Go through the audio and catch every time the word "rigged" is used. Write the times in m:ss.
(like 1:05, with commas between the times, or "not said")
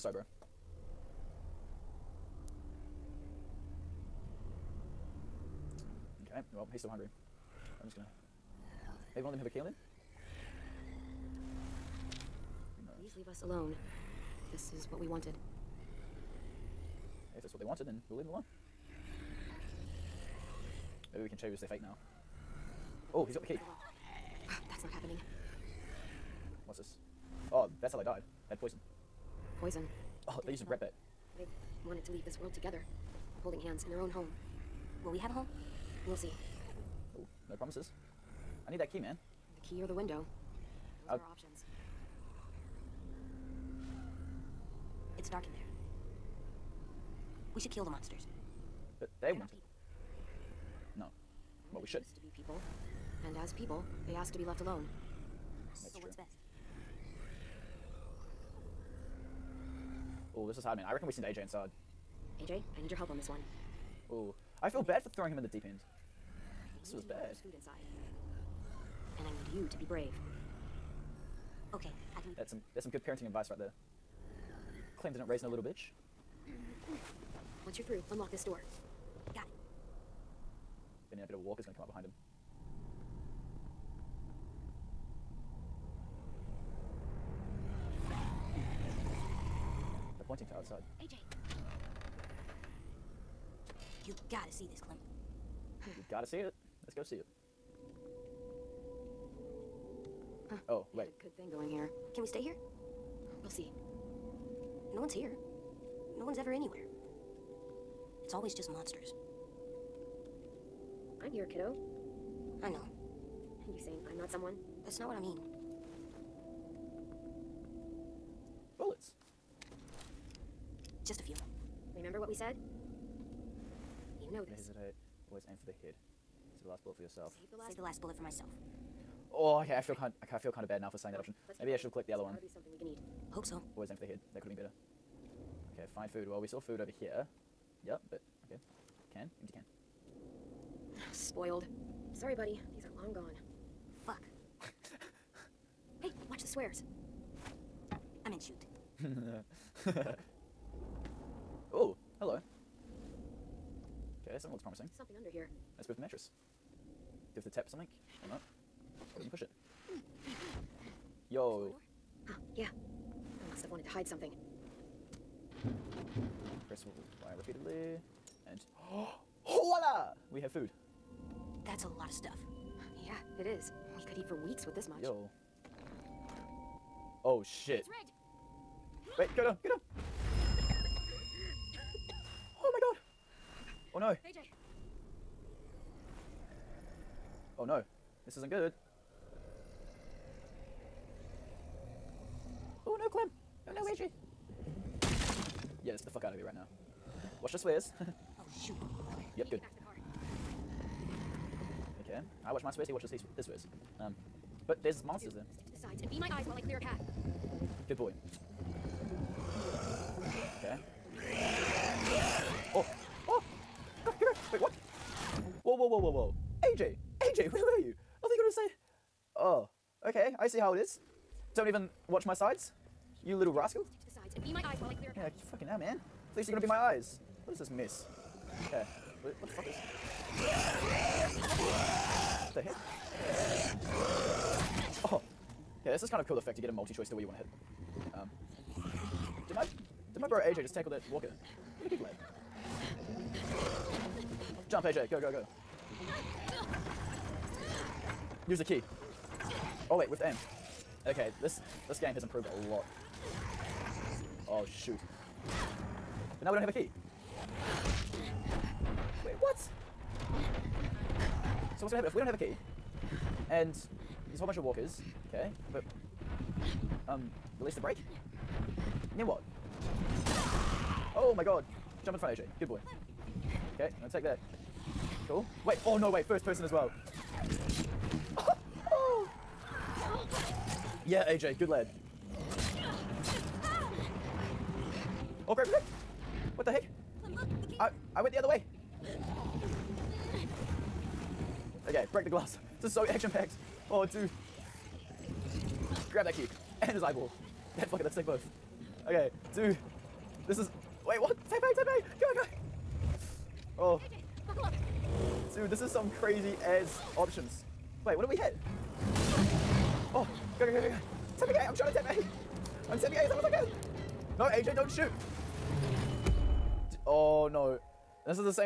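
2:57.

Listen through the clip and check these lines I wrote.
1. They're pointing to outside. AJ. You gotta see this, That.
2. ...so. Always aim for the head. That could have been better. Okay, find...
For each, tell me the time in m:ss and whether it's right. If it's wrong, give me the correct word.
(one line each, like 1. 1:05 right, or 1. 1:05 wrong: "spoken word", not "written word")
1. 1:30 wrong: "Clem", not "That"
2. 2:13 right.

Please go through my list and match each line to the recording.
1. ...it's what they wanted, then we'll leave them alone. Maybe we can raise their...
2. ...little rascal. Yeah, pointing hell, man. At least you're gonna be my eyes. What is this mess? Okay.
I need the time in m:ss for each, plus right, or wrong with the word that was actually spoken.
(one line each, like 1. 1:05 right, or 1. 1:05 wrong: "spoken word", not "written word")
1. 0:17 wrong: "choose", not "raise"
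2. 3:43 wrong: "fucking", not "pointing".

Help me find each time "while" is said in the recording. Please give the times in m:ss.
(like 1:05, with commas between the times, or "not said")
3:26.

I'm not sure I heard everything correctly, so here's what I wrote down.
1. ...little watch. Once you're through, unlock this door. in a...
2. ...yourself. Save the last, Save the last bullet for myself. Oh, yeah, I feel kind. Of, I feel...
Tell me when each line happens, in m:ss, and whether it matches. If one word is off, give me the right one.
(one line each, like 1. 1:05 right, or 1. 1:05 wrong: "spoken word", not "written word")
1. 1:15 wrong: "bitch", not "watch"
2. 2:07 right.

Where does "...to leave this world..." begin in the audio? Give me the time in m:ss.
0:32.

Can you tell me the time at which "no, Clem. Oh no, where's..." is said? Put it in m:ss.
3:13.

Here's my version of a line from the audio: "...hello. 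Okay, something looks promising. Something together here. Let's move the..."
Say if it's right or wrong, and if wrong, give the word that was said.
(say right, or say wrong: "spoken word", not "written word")
wrong: "under", not "together".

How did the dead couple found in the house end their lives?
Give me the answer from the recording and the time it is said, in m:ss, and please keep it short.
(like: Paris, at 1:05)
Poison, at 0:28.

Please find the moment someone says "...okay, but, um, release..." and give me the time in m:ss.
4:25.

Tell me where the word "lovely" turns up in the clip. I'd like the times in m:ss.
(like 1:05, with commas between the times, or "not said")
not said.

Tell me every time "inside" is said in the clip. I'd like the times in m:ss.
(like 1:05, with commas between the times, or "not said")
1:01, 1:07.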